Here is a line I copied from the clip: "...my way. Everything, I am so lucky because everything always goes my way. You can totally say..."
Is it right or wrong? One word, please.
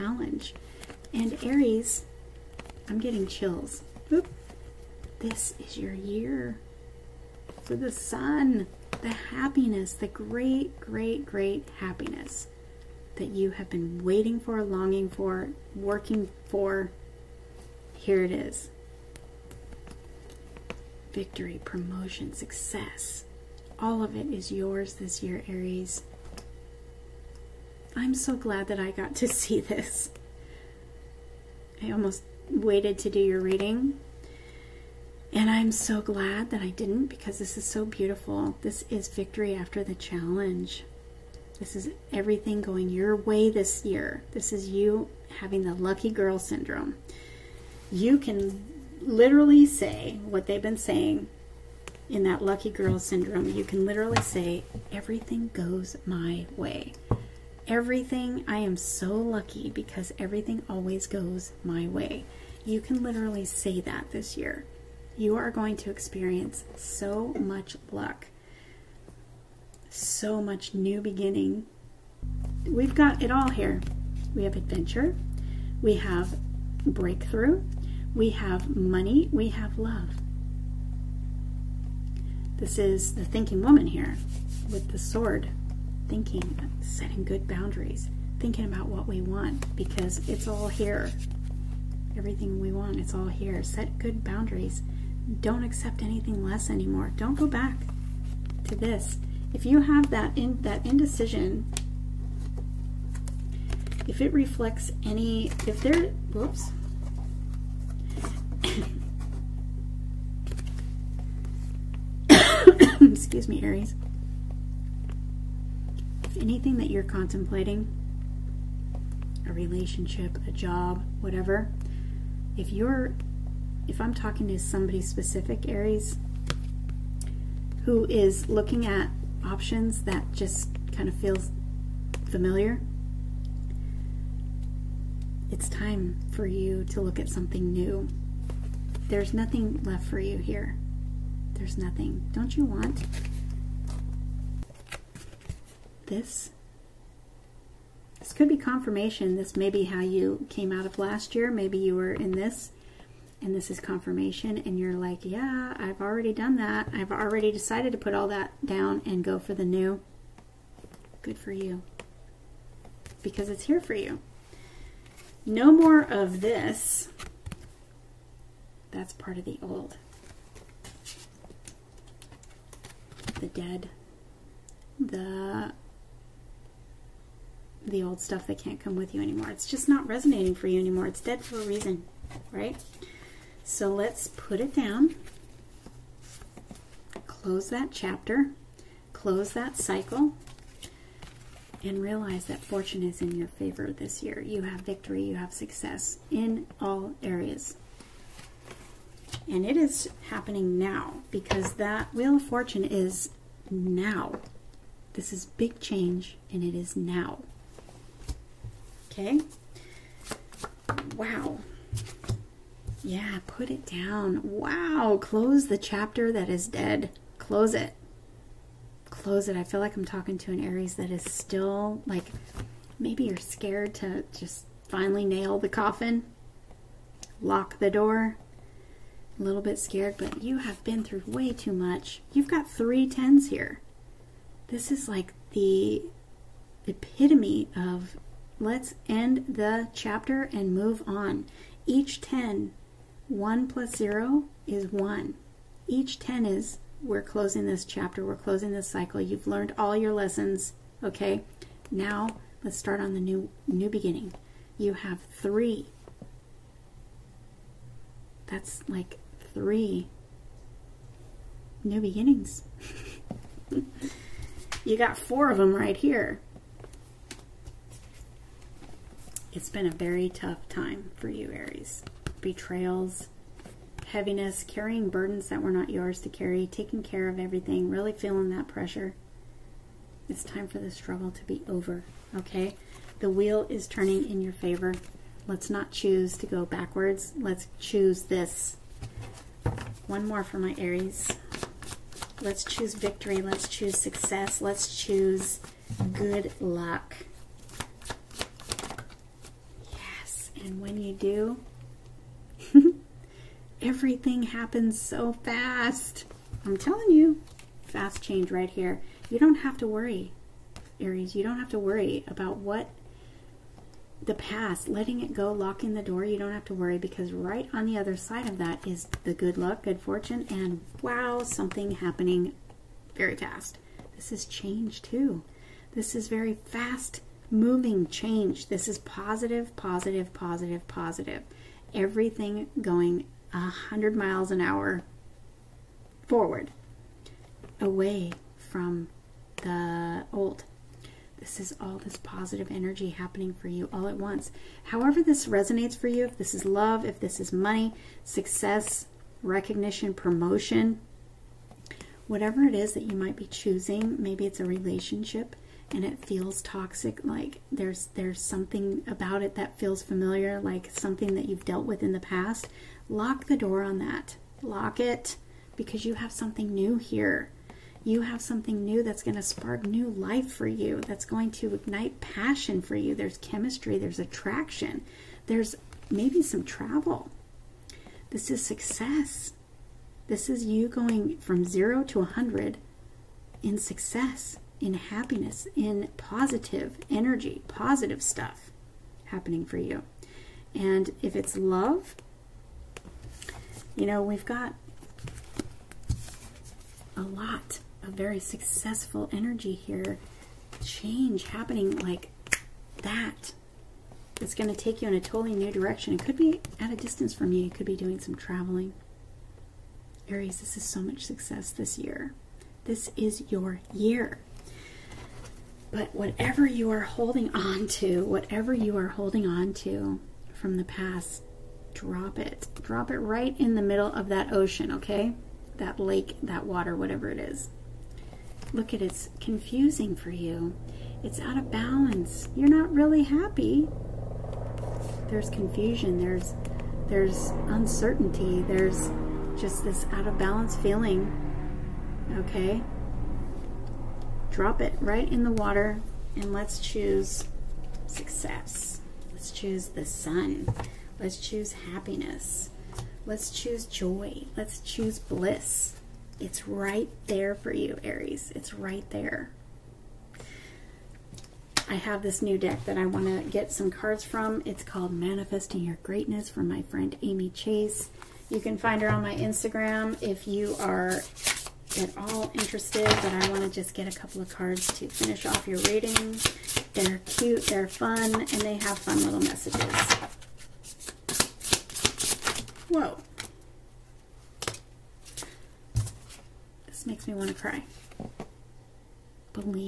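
wrong.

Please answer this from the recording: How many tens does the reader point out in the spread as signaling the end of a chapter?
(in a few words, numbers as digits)
3.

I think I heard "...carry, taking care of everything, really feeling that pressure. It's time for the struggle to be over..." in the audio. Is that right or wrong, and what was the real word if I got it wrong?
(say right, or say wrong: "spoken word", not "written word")
right.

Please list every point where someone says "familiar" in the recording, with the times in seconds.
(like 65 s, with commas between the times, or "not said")
132 s, 360 s.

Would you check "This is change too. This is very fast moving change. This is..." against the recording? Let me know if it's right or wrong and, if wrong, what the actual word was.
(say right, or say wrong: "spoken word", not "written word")
right.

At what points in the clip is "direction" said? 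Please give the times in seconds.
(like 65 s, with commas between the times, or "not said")
405 s.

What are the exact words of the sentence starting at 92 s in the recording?
Everything we want, it's all here.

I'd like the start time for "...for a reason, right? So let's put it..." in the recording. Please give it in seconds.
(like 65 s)
181 s.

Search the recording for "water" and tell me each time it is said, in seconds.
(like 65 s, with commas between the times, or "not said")
426 s, 445 s.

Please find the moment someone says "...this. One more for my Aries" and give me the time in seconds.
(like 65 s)
288 s.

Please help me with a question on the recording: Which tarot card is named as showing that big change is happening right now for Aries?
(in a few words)
Wheel of Fortune.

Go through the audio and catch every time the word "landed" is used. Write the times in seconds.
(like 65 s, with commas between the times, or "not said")
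not said.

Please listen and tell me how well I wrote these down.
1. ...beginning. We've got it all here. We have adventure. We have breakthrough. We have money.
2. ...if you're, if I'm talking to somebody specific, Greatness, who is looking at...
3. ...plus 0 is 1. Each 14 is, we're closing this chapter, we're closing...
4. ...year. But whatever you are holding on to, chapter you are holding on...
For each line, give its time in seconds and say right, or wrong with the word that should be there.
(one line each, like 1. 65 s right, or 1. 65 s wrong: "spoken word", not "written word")
1. 71 s right
2. 122 s wrong: "Aries", not "Greatness"
3. 243 s wrong: "10", not "14"
4. 413 s wrong: "whatever", not "chapter".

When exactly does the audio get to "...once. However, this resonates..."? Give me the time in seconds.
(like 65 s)
344 s.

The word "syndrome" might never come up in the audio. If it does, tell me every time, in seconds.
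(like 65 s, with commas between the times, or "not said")
46 s, 52 s.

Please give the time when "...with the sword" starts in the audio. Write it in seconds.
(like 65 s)
84 s.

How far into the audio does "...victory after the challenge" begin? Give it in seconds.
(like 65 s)
39 s.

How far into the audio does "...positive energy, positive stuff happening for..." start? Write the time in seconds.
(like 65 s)
386 s.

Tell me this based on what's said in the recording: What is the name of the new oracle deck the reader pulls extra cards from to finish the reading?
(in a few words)
Manifesting Your Greatness.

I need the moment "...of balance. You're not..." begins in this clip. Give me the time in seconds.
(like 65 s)
431 s.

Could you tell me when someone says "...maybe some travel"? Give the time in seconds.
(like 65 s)
376 s.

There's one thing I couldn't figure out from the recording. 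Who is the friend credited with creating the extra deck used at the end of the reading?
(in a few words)
Amy Chase.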